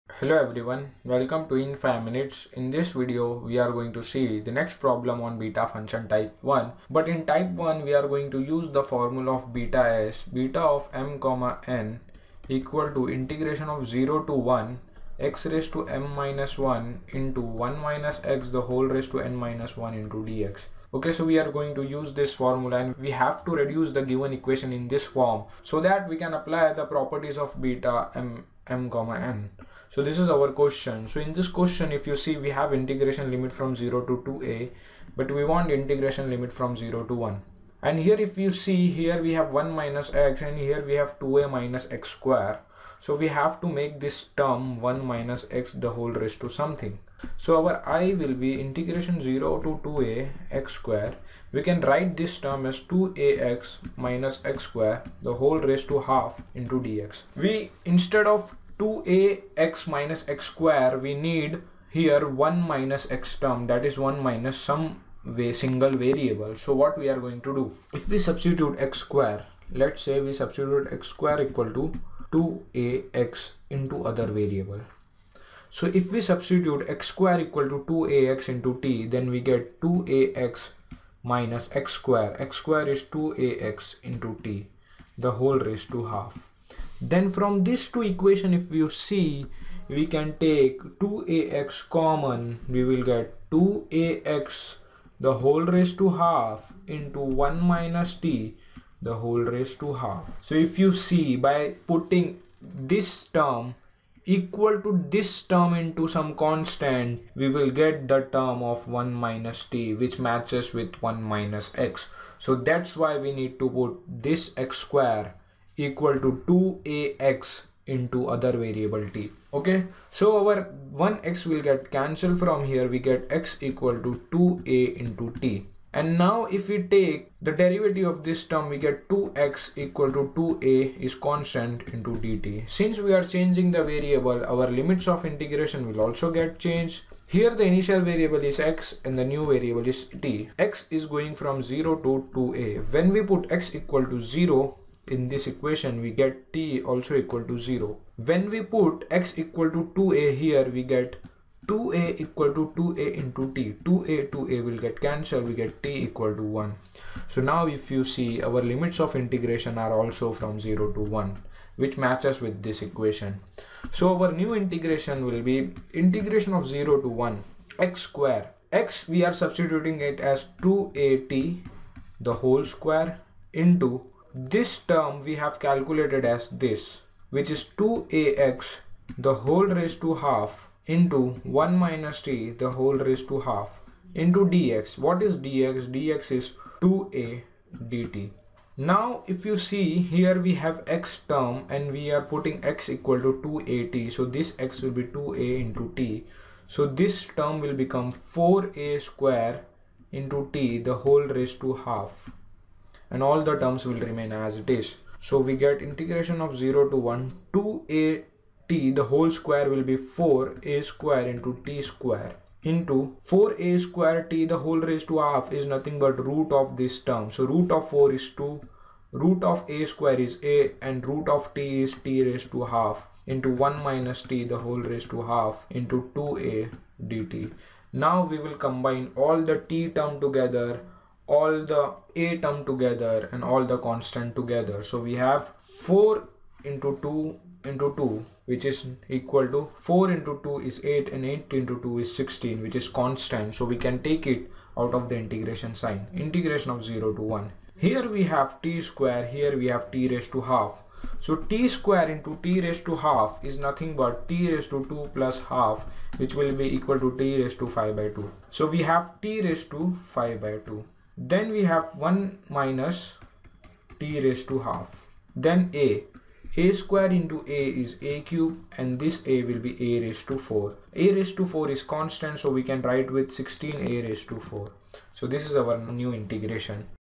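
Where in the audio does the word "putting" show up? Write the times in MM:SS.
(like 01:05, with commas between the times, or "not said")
01:41, 03:12.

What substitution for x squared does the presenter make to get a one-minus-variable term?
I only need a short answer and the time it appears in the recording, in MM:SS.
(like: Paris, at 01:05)
x^2 = 2ax·t, at 01:16.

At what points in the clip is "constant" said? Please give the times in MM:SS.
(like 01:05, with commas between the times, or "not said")
01:46, 02:11, 03:53, 04:02, 04:31.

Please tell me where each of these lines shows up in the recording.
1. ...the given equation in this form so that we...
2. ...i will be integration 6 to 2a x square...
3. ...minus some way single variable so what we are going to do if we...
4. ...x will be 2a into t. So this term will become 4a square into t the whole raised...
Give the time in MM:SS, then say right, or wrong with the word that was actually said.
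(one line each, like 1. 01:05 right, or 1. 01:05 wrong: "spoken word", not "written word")
1. 00:23 right
2. 00:47 wrong: "0", not "6"
3. 01:04 right
4. 03:14 right.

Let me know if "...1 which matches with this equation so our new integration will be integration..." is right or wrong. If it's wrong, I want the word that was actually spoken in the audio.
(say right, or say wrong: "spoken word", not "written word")
right.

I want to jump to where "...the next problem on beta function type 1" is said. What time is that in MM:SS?
00:04.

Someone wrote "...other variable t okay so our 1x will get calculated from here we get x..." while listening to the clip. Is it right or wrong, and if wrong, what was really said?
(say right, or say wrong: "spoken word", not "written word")
wrong: "cancelled", not "calculated".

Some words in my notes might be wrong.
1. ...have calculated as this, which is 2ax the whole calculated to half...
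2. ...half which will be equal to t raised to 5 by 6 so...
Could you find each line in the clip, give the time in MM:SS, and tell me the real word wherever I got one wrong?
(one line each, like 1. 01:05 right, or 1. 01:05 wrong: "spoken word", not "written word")
1. 02:55 wrong: "raised", not "calculated"
2. 04:15 wrong: "2", not "6".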